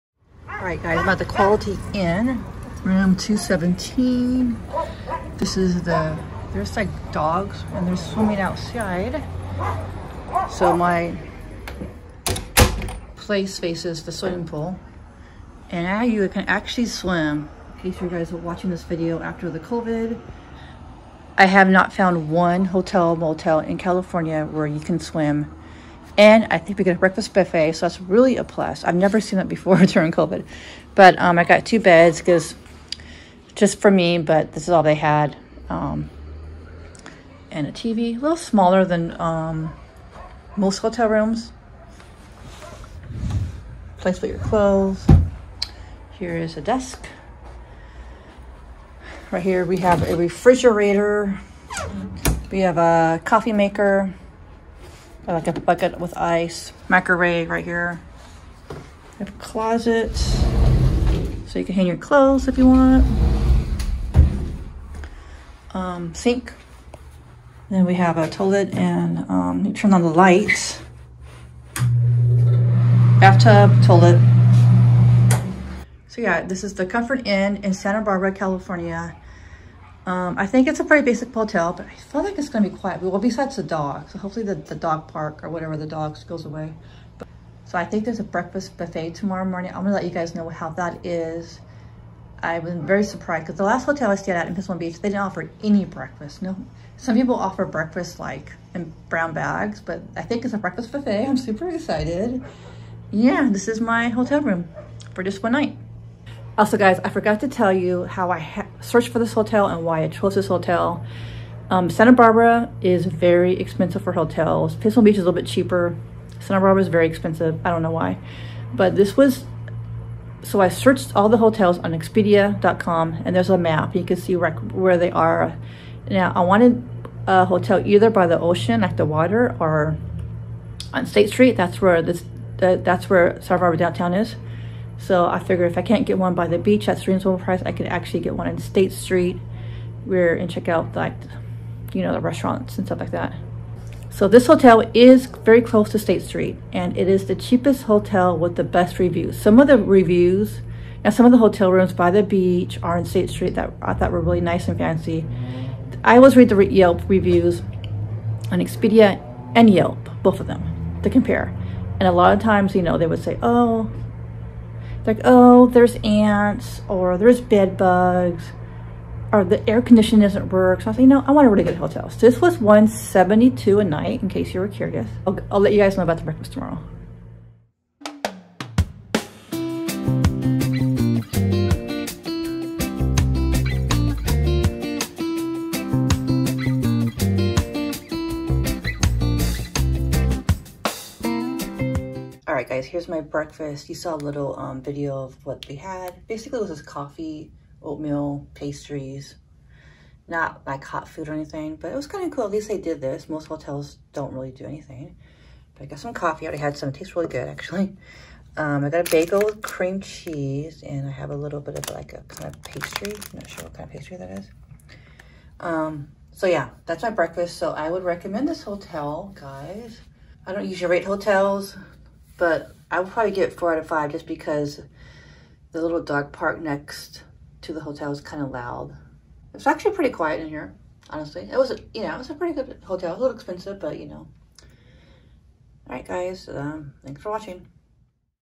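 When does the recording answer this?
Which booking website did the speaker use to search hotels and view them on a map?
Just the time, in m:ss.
2:01.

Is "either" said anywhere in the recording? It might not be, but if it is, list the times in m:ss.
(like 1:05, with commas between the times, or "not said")
2:07.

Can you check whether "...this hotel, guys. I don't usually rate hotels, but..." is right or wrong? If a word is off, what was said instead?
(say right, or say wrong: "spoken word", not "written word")
right.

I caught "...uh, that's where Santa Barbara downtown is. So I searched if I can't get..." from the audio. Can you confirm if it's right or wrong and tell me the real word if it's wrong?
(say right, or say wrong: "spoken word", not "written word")
wrong: "figured", not "searched".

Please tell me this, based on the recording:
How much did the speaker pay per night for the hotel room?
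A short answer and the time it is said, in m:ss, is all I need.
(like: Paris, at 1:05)
172, at 2:52.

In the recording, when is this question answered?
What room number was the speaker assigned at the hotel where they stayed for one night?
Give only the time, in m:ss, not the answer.
0:02.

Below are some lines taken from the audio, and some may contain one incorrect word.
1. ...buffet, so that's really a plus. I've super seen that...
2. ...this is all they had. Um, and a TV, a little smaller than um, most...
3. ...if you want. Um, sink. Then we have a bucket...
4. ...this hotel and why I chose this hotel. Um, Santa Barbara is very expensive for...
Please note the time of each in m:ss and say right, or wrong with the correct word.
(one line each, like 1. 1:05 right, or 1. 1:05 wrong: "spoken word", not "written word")
1. 0:27 wrong: "never", not "super"
2. 0:34 right
3. 1:02 wrong: "toilet", not "bucket"
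4. 1:49 right.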